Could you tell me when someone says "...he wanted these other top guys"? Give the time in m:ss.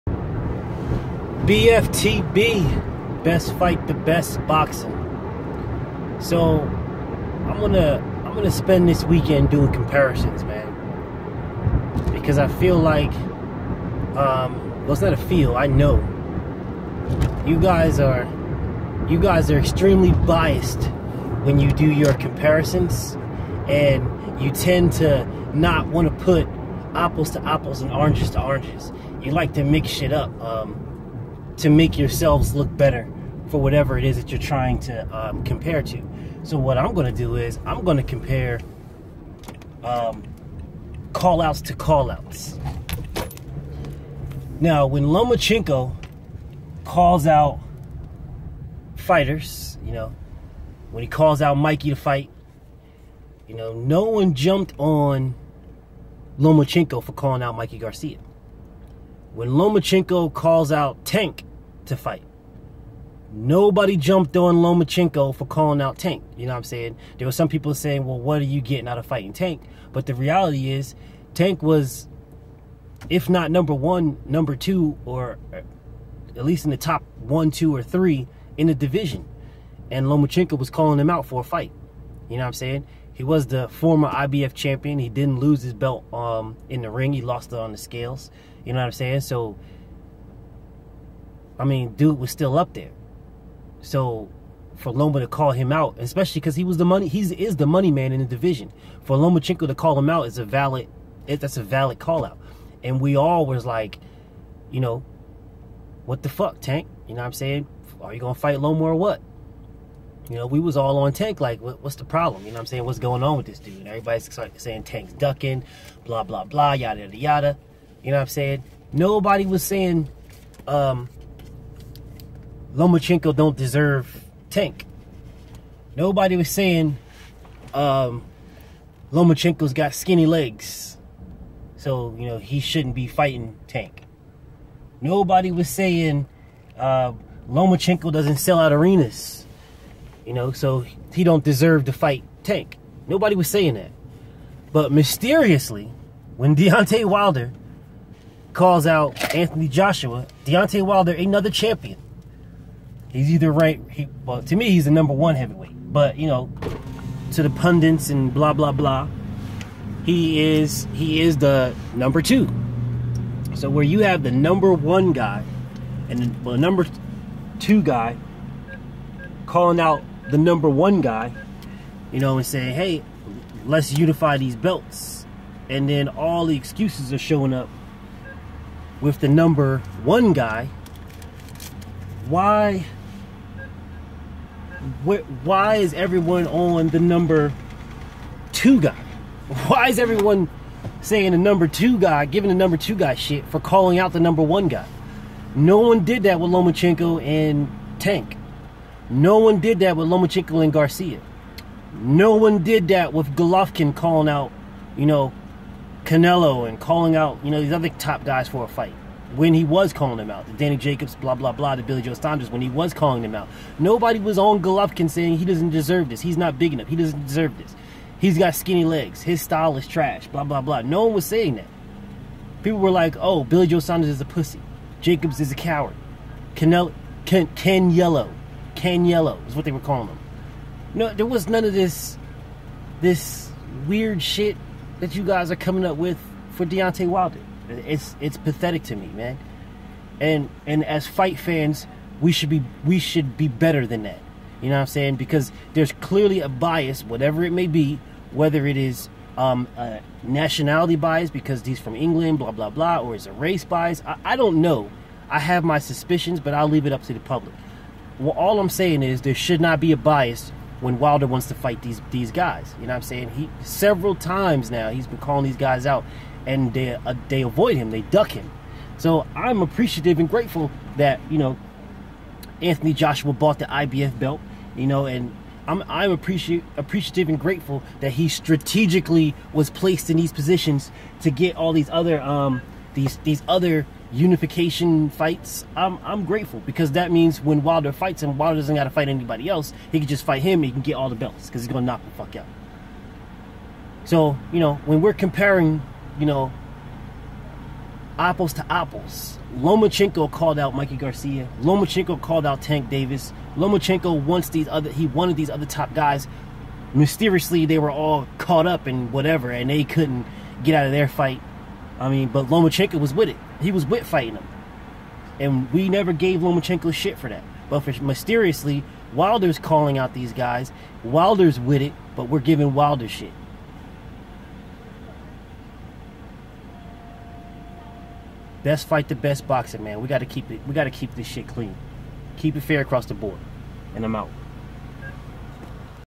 5:04.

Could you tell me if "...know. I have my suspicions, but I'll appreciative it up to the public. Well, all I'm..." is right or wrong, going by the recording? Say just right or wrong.
wrong.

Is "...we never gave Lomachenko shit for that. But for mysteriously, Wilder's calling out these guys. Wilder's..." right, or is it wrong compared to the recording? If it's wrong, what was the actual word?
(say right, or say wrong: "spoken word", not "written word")
right.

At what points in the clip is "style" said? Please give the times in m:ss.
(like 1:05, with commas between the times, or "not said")
3:39.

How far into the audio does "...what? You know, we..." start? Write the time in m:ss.
1:48.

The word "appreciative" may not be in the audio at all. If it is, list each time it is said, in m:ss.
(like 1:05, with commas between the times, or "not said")
4:29, 4:36.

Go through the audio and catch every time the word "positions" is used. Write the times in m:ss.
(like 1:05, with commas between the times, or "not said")
4:40.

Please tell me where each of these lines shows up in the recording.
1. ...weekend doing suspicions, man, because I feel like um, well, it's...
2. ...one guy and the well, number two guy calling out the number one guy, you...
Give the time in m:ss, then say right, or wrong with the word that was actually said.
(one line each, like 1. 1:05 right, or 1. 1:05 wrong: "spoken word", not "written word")
1. 0:09 wrong: "comparisons", not "suspicions"
2. 2:44 right.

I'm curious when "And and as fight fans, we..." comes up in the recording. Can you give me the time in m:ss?
4:00.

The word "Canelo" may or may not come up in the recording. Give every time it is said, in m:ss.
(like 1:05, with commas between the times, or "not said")
3:26, 3:46.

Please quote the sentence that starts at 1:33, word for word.
So for Loma to call him out, especially because he was the money, he's is the money man in the division.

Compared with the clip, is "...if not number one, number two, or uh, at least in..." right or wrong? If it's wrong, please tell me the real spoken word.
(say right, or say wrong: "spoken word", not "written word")
right.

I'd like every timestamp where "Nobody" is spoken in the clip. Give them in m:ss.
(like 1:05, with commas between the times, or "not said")
1:03, 1:58, 2:05, 2:15, 2:23, 3:33.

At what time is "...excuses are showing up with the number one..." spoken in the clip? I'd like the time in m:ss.
2:56.